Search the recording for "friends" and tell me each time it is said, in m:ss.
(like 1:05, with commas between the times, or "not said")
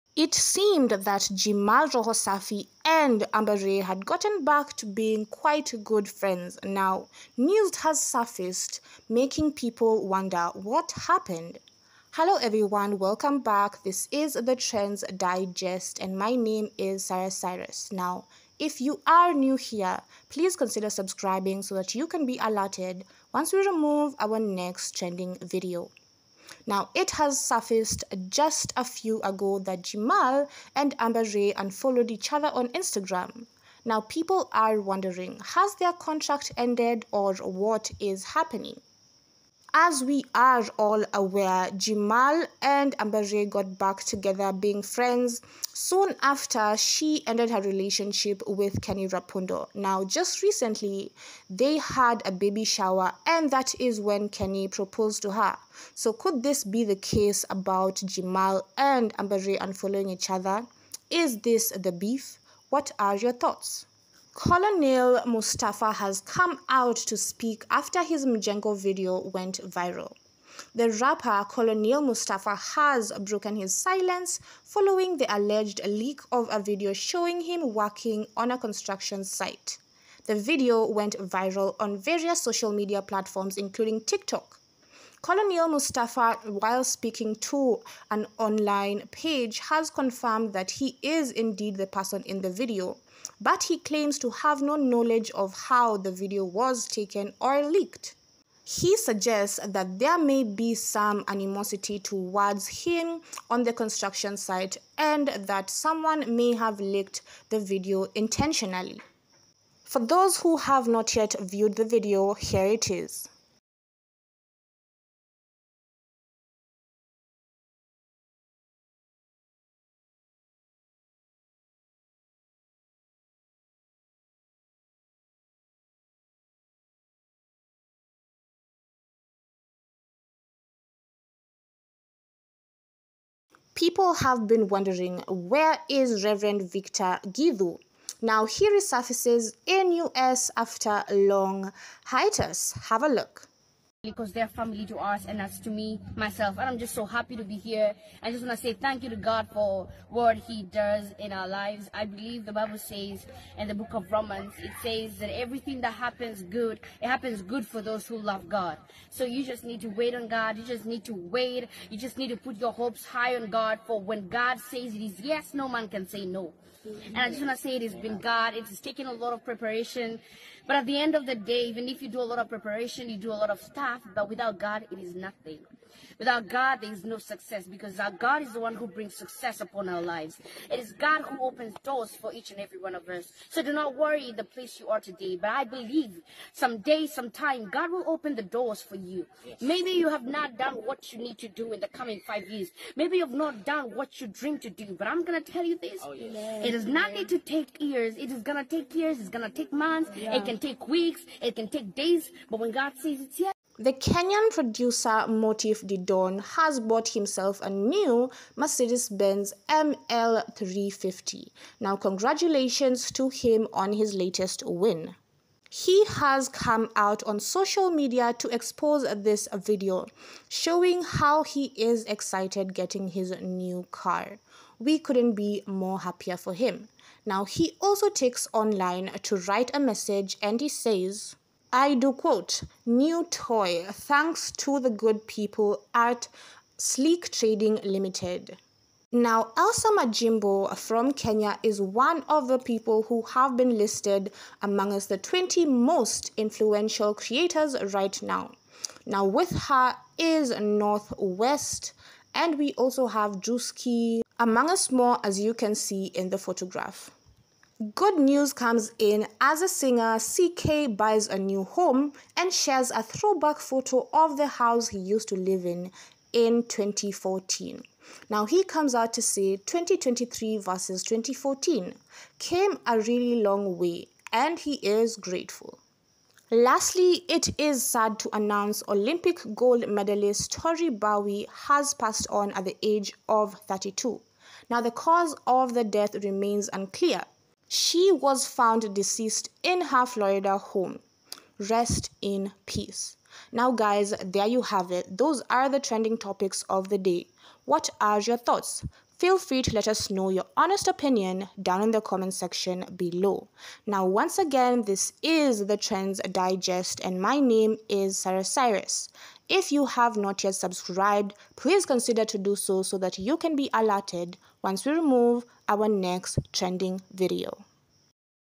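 0:06, 0:44.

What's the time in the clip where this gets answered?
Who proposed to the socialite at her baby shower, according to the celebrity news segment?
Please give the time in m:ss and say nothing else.
0:48.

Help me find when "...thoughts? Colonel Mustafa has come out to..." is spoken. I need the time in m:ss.
1:03.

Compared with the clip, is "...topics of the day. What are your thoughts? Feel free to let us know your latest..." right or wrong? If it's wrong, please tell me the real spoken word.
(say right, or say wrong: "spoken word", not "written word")
wrong: "honest", not "latest".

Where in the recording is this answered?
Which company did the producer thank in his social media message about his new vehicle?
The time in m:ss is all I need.
3:56.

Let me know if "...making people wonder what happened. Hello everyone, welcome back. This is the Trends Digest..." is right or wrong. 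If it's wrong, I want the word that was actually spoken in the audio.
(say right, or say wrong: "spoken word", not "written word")
right.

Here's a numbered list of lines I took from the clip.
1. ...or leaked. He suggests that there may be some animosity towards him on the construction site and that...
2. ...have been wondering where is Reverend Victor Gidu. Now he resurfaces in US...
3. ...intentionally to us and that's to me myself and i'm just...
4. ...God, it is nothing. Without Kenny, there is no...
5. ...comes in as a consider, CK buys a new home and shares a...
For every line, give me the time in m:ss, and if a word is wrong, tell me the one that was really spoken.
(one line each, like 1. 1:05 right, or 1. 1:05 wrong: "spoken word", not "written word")
1. 1:37 right
2. 2:14 right
3. 2:24 wrong: "family", not "intentionally"
4. 2:54 wrong: "God", not "Kenny"
5. 4:18 wrong: "singer", not "consider".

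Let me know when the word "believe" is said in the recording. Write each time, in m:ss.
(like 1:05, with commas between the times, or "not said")
2:32, 3:05.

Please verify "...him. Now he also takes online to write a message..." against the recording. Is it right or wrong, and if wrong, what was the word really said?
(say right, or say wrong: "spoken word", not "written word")
right.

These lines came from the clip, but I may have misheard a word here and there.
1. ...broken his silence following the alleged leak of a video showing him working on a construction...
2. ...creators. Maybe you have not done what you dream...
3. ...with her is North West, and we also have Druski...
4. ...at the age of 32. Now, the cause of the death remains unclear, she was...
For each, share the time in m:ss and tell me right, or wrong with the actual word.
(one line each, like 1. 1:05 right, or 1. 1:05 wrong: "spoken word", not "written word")
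1. 1:13 right
2. 3:12 wrong: "years", not "creators"
3. 4:09 right
4. 4:42 right.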